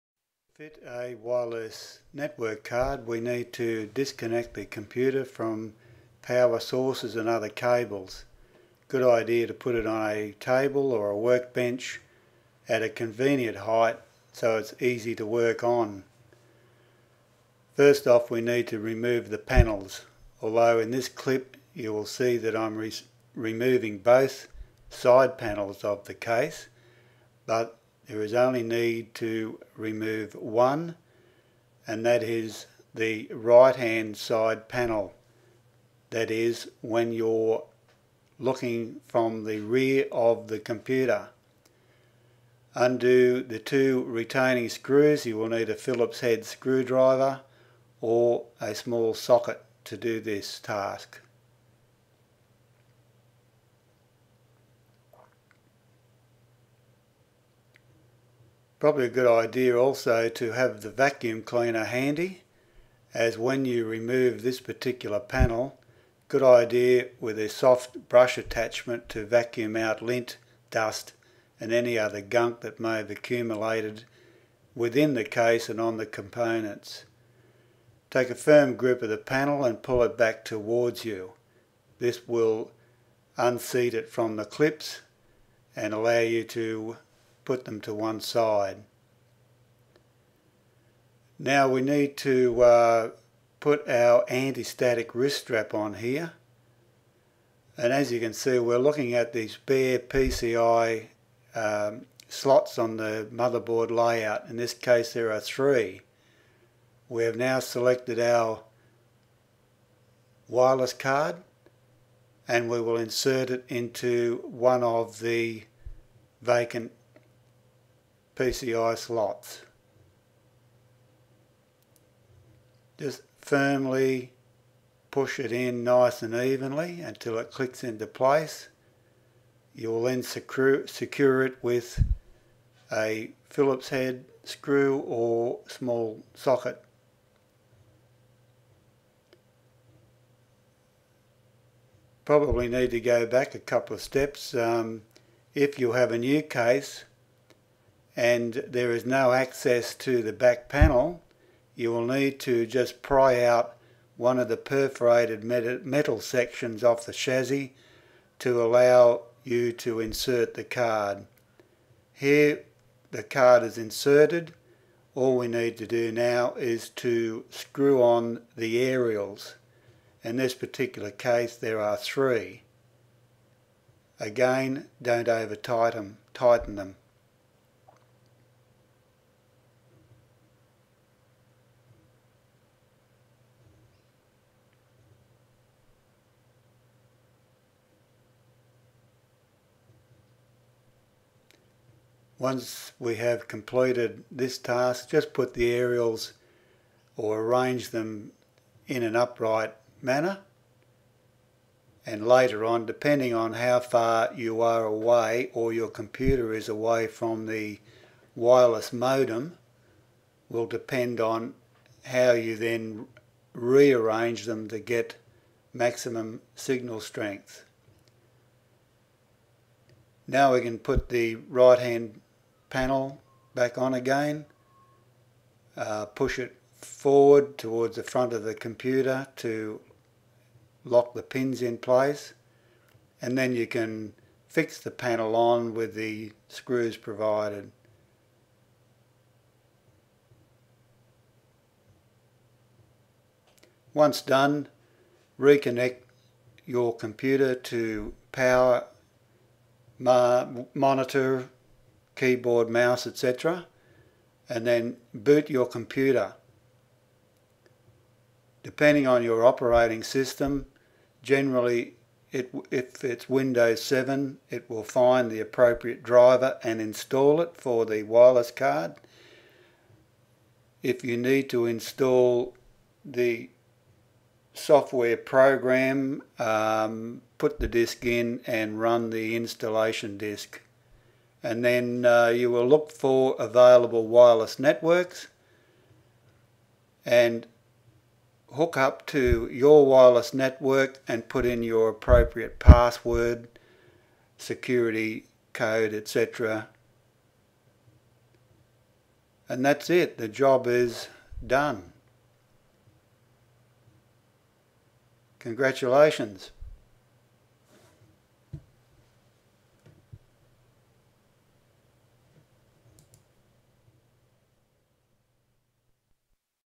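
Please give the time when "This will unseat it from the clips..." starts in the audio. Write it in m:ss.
1:21.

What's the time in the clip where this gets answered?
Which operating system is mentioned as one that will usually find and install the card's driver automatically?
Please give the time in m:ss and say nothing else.
4:23.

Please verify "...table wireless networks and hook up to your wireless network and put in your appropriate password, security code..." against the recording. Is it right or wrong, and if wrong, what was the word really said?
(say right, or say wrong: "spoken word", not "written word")
wrong: "available", not "table".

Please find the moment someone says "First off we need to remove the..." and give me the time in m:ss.
0:17.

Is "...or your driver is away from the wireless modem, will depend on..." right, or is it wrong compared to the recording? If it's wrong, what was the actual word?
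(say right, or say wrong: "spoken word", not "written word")
wrong: "computer", not "driver".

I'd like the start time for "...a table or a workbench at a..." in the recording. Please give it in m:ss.
0:10.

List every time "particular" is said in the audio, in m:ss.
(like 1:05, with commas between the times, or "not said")
1:04, 2:50.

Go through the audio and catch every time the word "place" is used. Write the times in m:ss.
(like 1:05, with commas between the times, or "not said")
2:08, 3:51.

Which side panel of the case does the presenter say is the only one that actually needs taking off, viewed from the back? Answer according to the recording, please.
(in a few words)
Right hand side panel.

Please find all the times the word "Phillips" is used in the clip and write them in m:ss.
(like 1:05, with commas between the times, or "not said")
0:45, 2:13.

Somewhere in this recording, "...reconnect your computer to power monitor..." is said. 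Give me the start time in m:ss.
4:05.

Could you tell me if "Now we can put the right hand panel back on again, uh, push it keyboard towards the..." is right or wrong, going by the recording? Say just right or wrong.
wrong.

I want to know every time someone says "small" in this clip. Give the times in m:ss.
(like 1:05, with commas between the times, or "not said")
0:48, 2:15.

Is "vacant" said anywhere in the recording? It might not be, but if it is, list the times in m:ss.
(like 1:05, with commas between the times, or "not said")
1:56.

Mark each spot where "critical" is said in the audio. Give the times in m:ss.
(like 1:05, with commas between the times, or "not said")
not said.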